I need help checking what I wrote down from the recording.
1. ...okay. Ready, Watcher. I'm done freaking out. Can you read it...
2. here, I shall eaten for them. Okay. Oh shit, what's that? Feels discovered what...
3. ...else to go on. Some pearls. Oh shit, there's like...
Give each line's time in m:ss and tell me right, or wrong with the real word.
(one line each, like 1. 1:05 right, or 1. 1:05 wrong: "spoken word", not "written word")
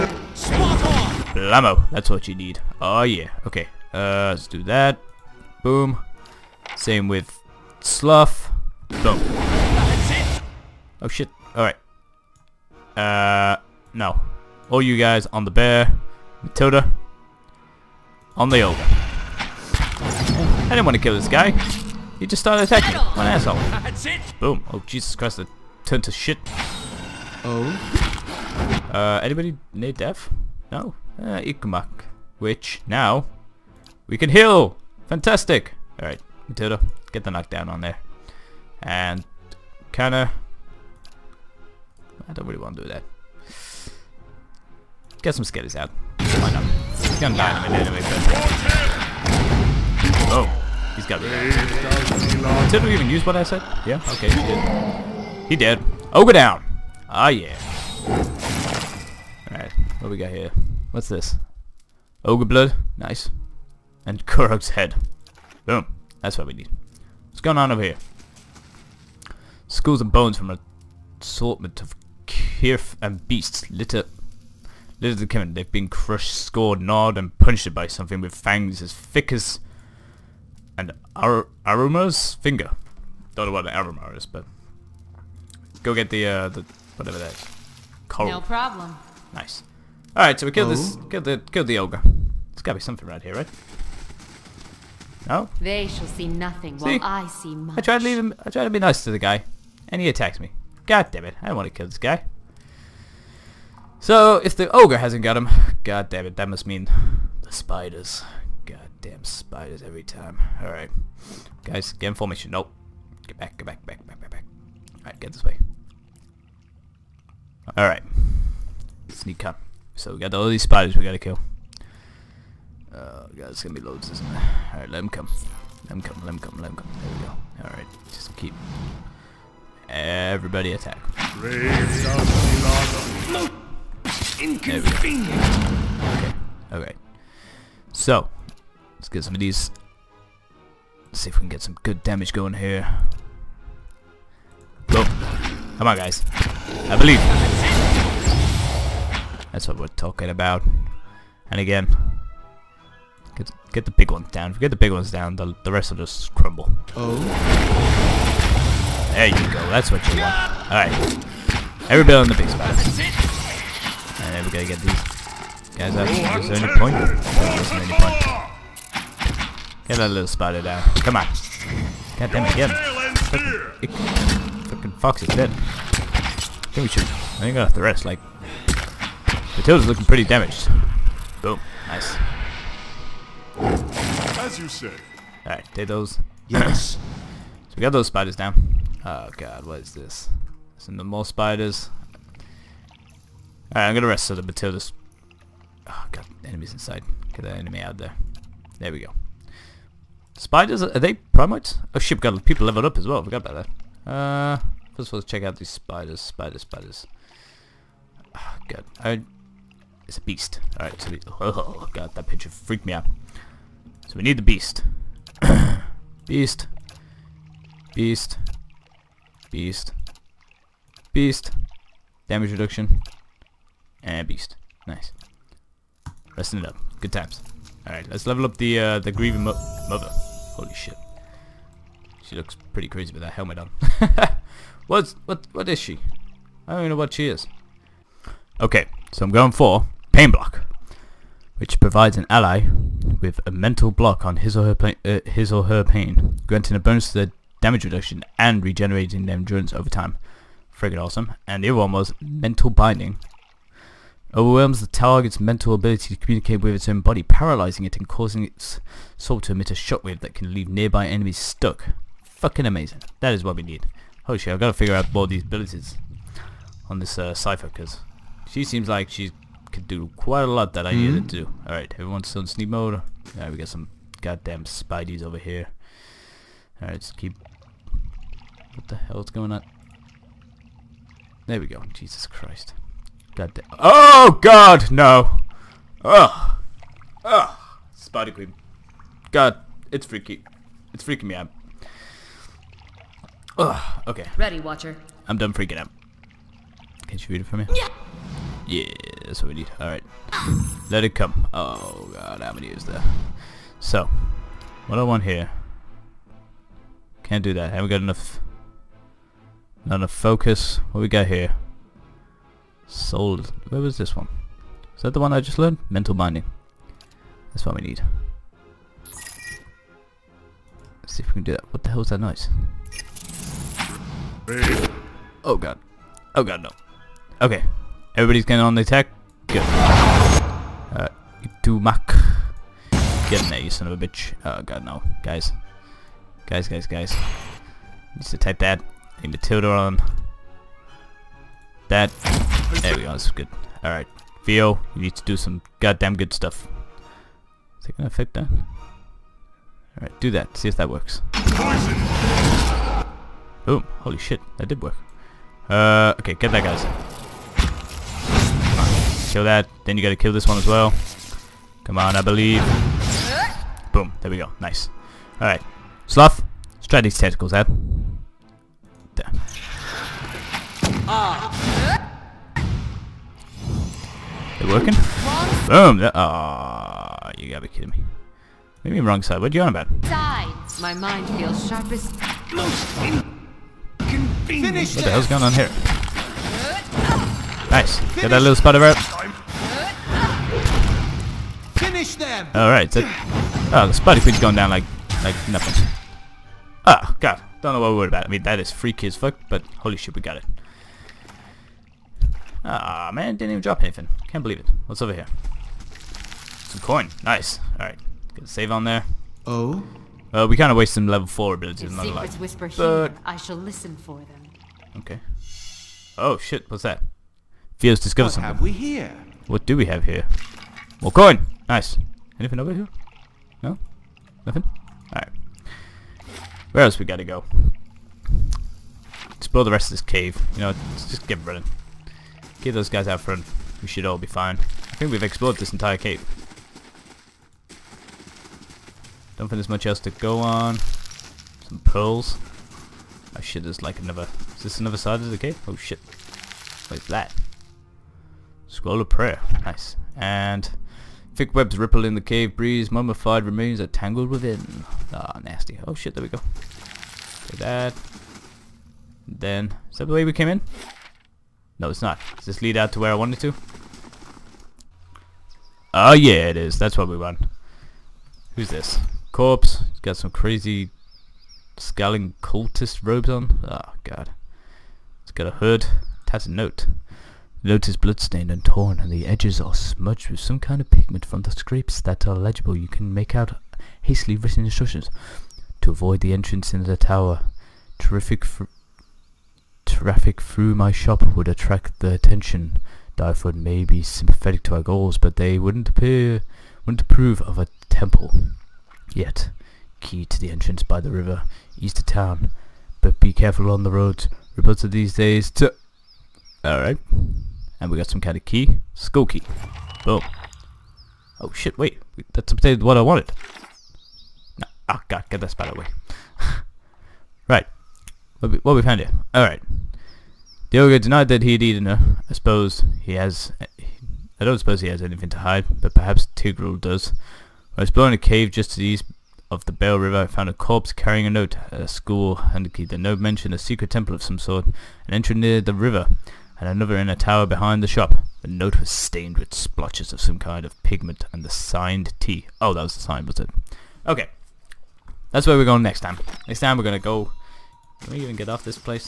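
1. 4:54 right
2. 6:53 wrong: "listen", not "eaten"
3. 7:19 right.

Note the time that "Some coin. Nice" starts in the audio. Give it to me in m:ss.
6:46.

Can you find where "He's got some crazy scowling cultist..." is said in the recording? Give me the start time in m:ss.
7:49.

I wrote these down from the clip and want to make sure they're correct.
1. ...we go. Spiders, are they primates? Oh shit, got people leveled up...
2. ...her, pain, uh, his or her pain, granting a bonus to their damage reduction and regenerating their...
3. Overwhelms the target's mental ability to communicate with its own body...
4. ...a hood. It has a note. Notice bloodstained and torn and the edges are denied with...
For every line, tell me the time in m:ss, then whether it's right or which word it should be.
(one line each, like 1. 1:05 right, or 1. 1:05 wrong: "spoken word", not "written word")
1. 3:18 right
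2. 4:04 right
3. 4:14 right
4. 7:55 wrong: "smudged", not "denied".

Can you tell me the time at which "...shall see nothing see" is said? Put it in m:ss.
1:35.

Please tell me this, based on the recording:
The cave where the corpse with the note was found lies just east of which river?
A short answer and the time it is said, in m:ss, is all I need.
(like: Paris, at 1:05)
Bell River, at 8:49.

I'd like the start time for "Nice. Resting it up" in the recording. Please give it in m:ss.
3:44.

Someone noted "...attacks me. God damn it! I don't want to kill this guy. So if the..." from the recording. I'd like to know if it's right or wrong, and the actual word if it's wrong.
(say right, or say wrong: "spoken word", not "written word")
right.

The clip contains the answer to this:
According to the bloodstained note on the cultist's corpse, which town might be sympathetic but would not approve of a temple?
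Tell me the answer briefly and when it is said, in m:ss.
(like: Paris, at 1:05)
Dyrford, at 8:13.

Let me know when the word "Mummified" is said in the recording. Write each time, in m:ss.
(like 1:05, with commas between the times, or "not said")
7:32.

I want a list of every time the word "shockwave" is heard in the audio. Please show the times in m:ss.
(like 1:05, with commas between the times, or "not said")
4:19.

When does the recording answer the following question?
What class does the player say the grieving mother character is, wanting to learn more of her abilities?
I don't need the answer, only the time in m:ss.
4:27.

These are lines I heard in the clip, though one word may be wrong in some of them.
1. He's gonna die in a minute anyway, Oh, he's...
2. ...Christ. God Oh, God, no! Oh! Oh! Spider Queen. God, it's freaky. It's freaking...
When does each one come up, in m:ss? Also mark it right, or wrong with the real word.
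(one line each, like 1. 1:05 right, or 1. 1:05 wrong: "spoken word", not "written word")
1. 0:46 right
2. 4:42 right.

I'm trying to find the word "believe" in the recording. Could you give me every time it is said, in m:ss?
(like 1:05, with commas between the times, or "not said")
2:26, 6:02, 6:44.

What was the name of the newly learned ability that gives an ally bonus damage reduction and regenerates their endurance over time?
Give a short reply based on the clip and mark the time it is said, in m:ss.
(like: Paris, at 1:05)
Pain Block, at 4:00.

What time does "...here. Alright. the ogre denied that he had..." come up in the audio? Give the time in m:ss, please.
8:38.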